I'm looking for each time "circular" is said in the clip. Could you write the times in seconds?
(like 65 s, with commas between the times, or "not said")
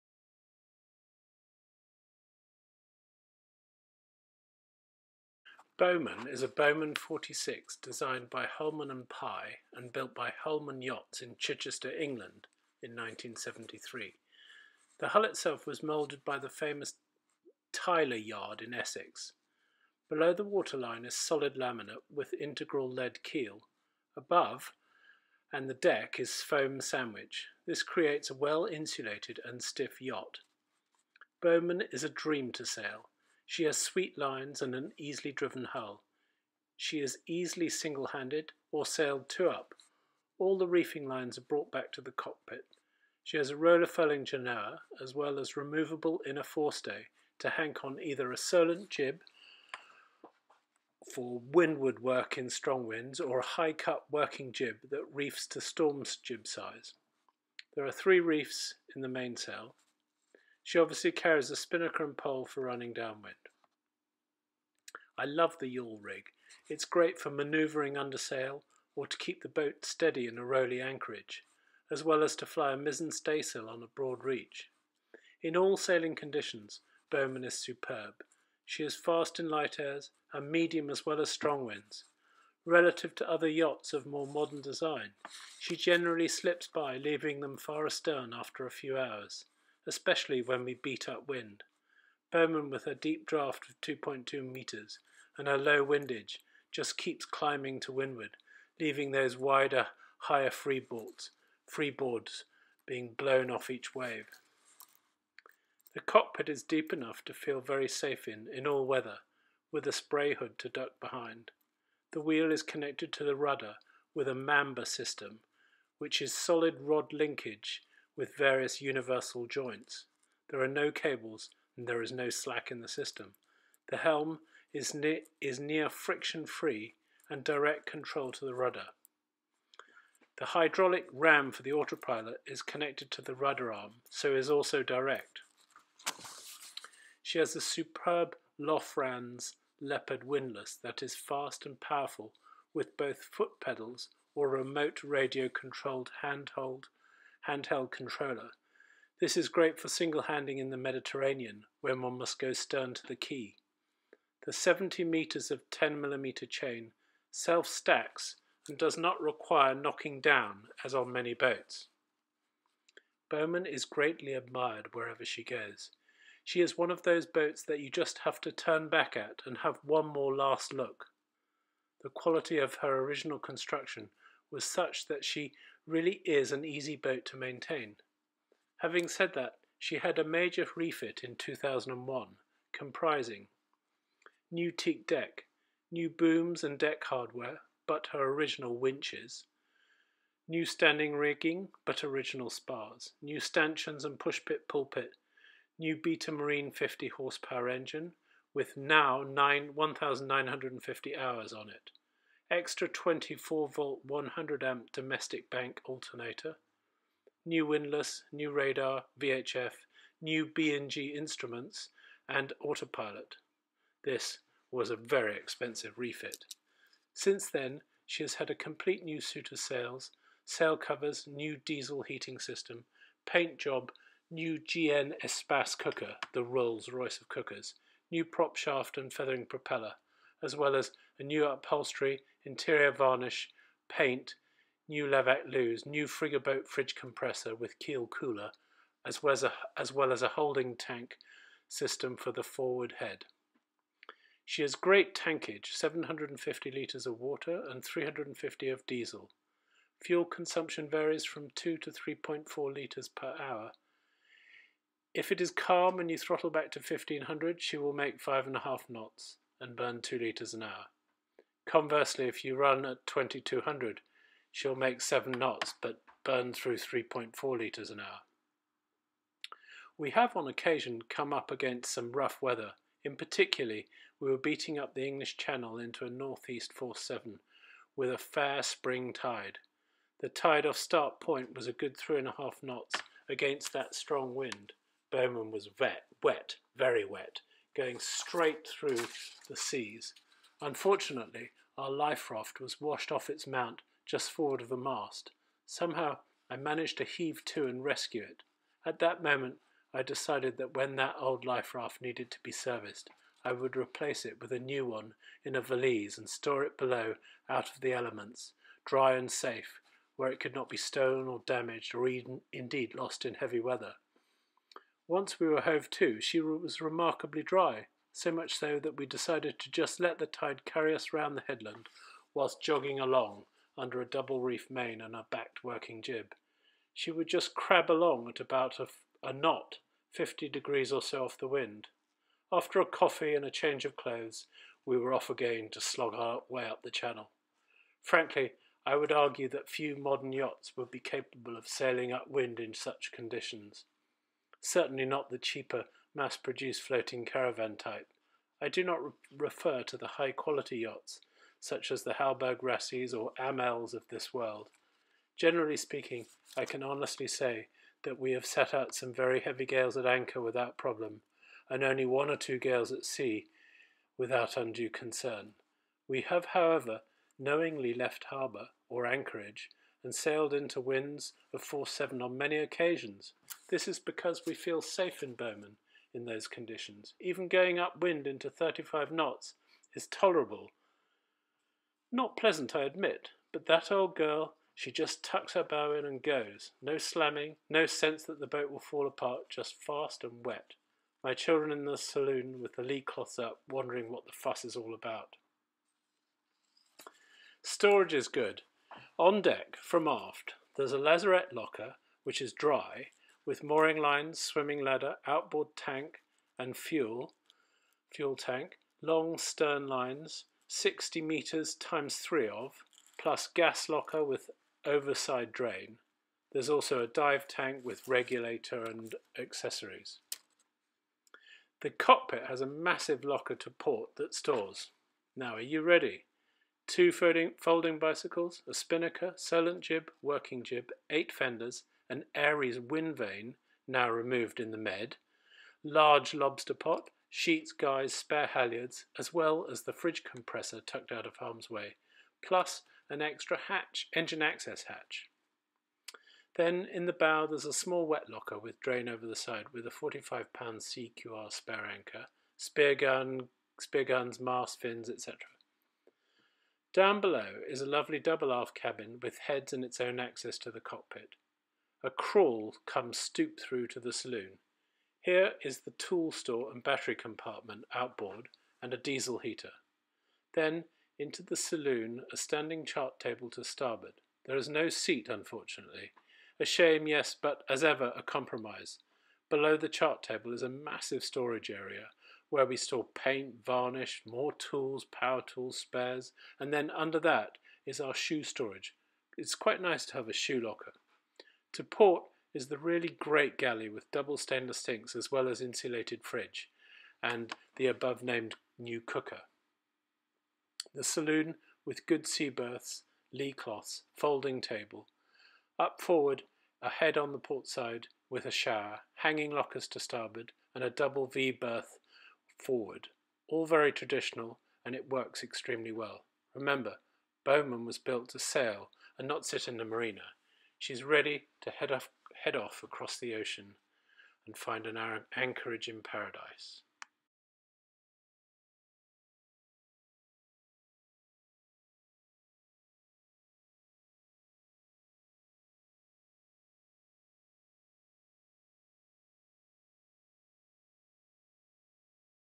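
not said.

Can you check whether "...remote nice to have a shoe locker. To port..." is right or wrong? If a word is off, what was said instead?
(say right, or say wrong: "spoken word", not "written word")
wrong: "quite", not "remote".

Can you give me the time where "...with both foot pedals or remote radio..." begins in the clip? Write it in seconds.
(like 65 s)
142 s.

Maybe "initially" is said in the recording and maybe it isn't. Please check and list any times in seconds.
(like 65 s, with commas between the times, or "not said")
not said.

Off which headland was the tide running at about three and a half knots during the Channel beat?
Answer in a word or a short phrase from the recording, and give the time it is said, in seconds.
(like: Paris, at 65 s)
Start Point, at 280 s.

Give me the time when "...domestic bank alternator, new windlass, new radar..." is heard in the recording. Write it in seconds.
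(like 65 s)
204 s.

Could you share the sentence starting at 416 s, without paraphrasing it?
There's also a dive tank with regulator and accessories.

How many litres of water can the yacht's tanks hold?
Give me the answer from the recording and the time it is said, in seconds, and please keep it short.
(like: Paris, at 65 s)
750 litres, at 245 s.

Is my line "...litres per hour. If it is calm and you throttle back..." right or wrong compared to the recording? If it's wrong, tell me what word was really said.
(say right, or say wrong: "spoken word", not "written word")
right.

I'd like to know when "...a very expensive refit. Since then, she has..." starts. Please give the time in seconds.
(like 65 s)
214 s.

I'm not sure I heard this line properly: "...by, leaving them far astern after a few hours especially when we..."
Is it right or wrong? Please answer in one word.
right.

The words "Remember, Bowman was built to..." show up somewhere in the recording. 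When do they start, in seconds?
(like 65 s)
516 s.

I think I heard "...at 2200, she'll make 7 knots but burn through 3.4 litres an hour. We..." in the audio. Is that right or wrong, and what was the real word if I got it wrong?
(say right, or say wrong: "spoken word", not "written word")
right.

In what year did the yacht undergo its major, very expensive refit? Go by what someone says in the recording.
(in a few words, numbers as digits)
2001.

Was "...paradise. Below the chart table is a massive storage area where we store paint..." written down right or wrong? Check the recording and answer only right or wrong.
wrong.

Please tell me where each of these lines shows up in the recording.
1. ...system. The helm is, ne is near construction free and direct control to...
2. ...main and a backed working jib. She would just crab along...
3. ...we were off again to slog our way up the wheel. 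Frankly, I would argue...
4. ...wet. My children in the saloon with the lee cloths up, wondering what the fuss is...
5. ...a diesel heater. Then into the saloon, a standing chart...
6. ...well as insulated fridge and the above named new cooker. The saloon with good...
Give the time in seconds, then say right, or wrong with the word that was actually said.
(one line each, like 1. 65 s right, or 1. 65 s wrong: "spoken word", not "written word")
1. 122 s wrong: "friction", not "construction"
2. 324 s right
3. 334 s wrong: "channel", not "wheel"
4. 390 s right
5. 468 s right
6. 495 s right.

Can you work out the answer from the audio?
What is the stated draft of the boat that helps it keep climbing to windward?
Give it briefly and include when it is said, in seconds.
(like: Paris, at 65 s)
2.2 metres, at 93 s.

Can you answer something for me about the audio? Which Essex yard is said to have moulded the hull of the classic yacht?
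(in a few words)
Tyler Yard.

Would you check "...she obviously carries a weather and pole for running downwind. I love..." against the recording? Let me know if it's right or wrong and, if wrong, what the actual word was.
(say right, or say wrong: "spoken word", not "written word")
wrong: "spinnaker", not "weather".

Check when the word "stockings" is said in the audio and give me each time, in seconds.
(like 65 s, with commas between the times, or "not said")
not said.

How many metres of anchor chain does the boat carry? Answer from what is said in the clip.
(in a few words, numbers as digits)
70 meters.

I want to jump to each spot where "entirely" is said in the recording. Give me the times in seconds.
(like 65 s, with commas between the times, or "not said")
not said.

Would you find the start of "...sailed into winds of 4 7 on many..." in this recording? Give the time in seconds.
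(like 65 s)
370 s.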